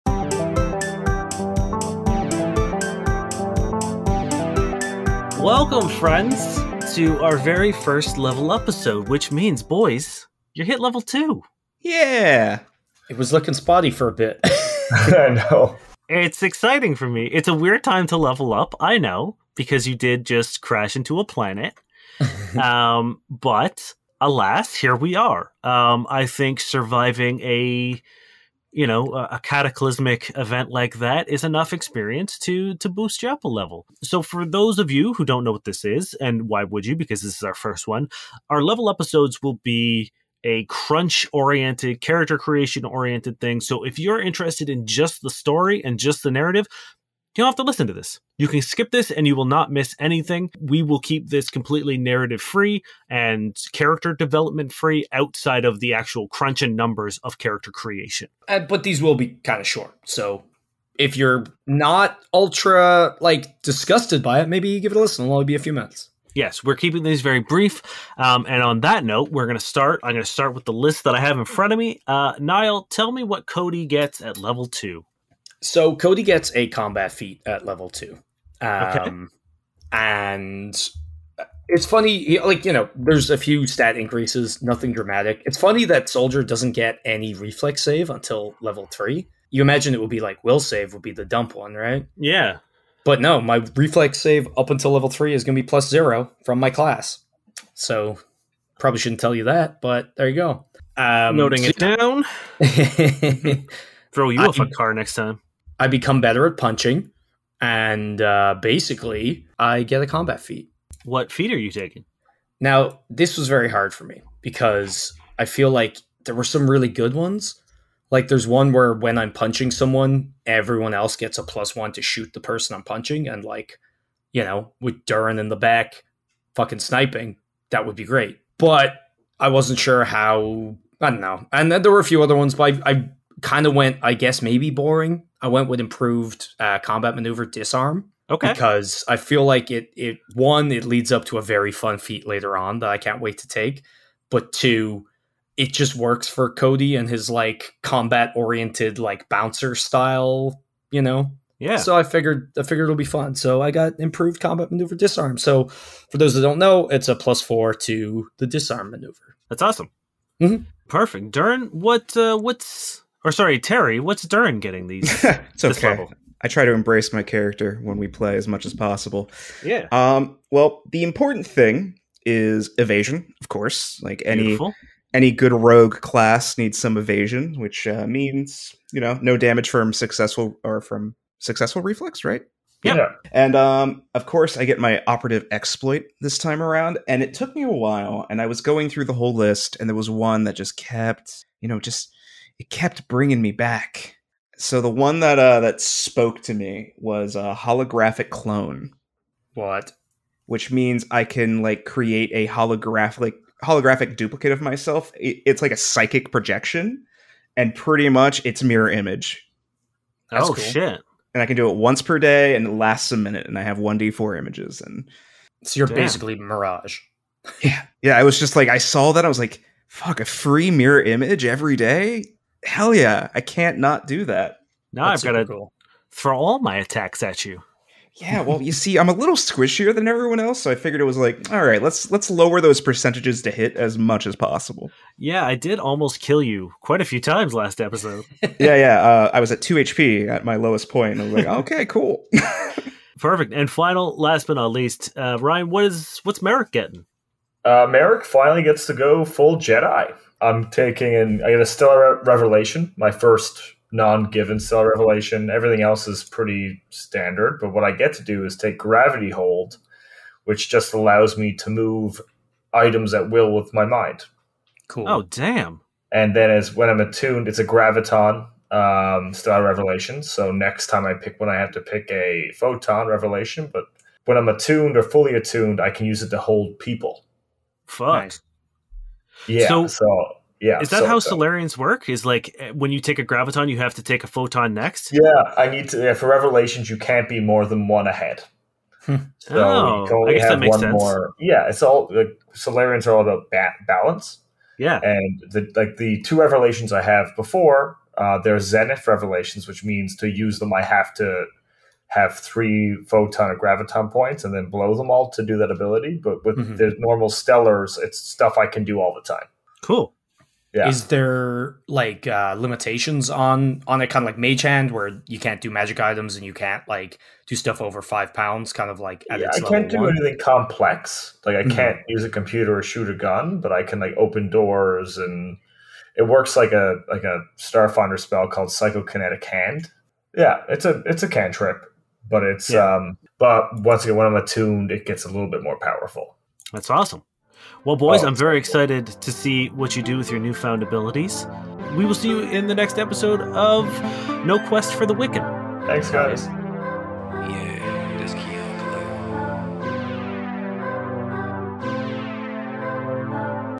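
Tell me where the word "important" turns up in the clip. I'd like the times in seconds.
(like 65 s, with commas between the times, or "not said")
171 s.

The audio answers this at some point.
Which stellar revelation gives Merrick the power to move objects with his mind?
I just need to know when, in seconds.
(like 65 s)
258 s.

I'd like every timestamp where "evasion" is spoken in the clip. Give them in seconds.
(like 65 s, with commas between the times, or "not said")
172 s, 176 s.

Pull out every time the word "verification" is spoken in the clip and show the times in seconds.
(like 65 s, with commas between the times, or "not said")
not said.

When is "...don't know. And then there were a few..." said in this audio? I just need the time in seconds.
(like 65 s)
131 s.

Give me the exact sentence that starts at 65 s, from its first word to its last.
It'll only be a few minutes.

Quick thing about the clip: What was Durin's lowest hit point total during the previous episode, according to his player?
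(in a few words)
2.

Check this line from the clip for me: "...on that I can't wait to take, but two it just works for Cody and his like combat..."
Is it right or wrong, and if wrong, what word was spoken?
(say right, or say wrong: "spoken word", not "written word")
right.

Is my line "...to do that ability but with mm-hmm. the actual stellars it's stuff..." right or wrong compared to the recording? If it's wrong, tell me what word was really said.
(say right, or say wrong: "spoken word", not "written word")
wrong: "normal", not "actual".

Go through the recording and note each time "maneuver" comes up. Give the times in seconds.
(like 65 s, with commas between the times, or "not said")
137 s, 154 s, 158 s.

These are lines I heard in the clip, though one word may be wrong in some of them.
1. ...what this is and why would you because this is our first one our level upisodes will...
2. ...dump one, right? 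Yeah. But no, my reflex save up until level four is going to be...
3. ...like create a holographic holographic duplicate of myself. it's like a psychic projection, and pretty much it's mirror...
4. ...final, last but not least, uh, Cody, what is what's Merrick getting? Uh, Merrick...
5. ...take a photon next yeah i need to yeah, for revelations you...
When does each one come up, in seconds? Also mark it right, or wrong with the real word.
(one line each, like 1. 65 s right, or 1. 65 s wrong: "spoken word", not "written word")
1. 35 s right
2. 91 s wrong: "three", not "four"
3. 201 s right
4. 243 s wrong: "Ryan", not "Cody"
5. 284 s right.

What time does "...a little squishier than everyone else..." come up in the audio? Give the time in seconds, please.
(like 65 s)
229 s.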